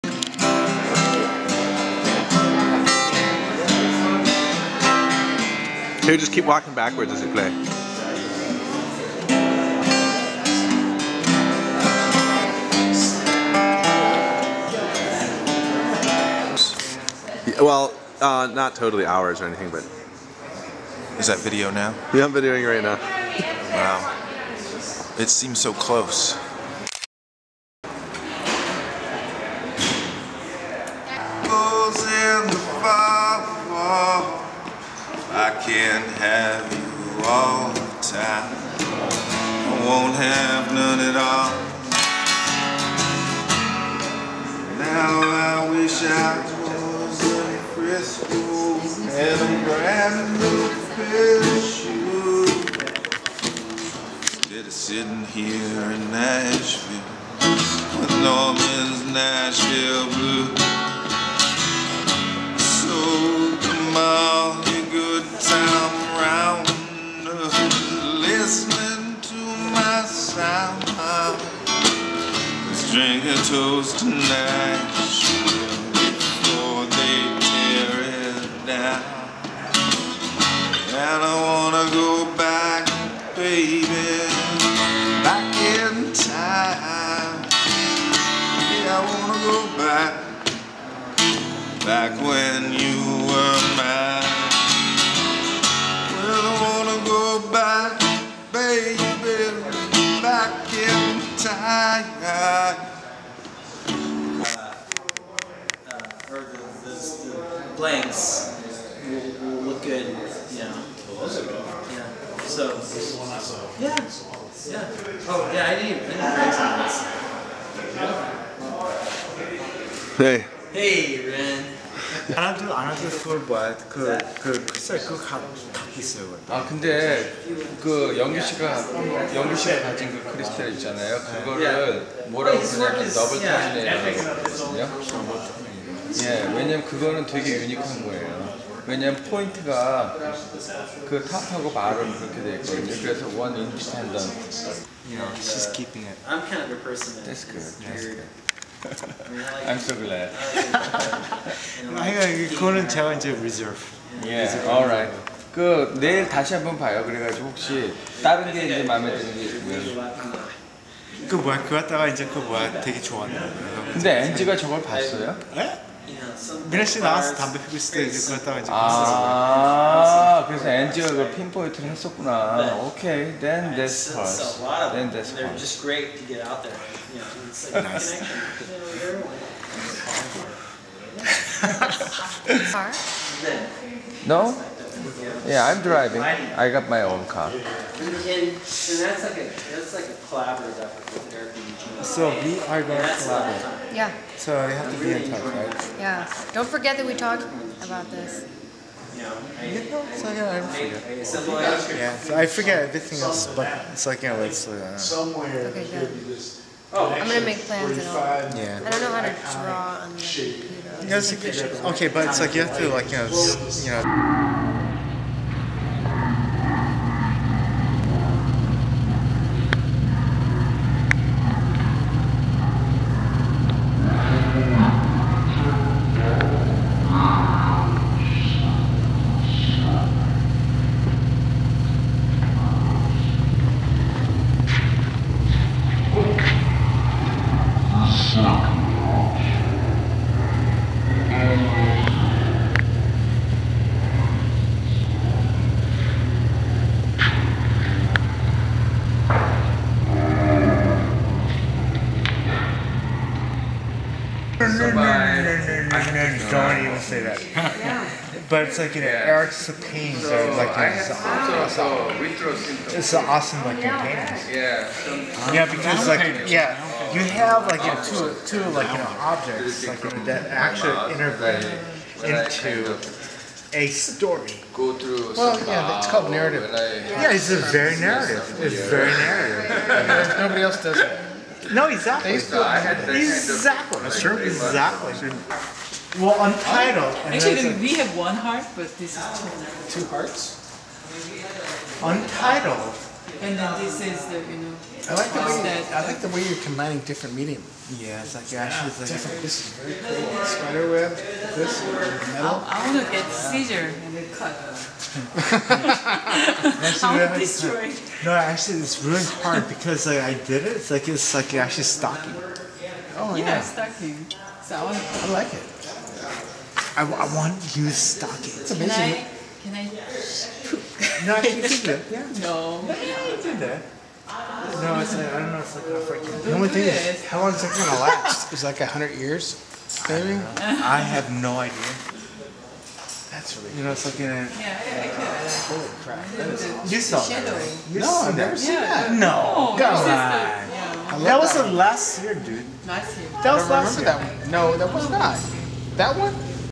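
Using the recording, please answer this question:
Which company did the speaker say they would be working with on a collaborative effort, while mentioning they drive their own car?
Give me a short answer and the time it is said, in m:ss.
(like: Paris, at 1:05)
Airbnb, at 3:11.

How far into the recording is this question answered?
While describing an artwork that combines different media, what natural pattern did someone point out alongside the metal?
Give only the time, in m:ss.
5:00.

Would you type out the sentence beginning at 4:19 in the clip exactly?
Eric so are like you know, so, awesome.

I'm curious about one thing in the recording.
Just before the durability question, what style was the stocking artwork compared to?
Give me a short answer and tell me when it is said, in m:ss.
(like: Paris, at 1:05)
African, at 5:26.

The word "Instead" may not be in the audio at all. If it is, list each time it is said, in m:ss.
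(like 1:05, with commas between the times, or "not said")
0:54.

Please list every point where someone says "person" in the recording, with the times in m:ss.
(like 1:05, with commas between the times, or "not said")
2:26.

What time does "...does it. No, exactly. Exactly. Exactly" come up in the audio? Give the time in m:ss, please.
4:40.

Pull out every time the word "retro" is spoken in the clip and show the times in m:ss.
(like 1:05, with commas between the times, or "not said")
4:22.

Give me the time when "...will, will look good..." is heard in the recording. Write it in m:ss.
1:49.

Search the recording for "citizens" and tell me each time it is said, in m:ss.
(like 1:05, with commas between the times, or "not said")
not said.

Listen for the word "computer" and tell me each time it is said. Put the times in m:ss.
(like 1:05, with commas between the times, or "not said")
3:31.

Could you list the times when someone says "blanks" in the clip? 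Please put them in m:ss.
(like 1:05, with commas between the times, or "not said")
1:47, 1:56.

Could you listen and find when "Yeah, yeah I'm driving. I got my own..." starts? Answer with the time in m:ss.
3:05.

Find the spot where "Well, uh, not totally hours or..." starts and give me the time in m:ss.
0:17.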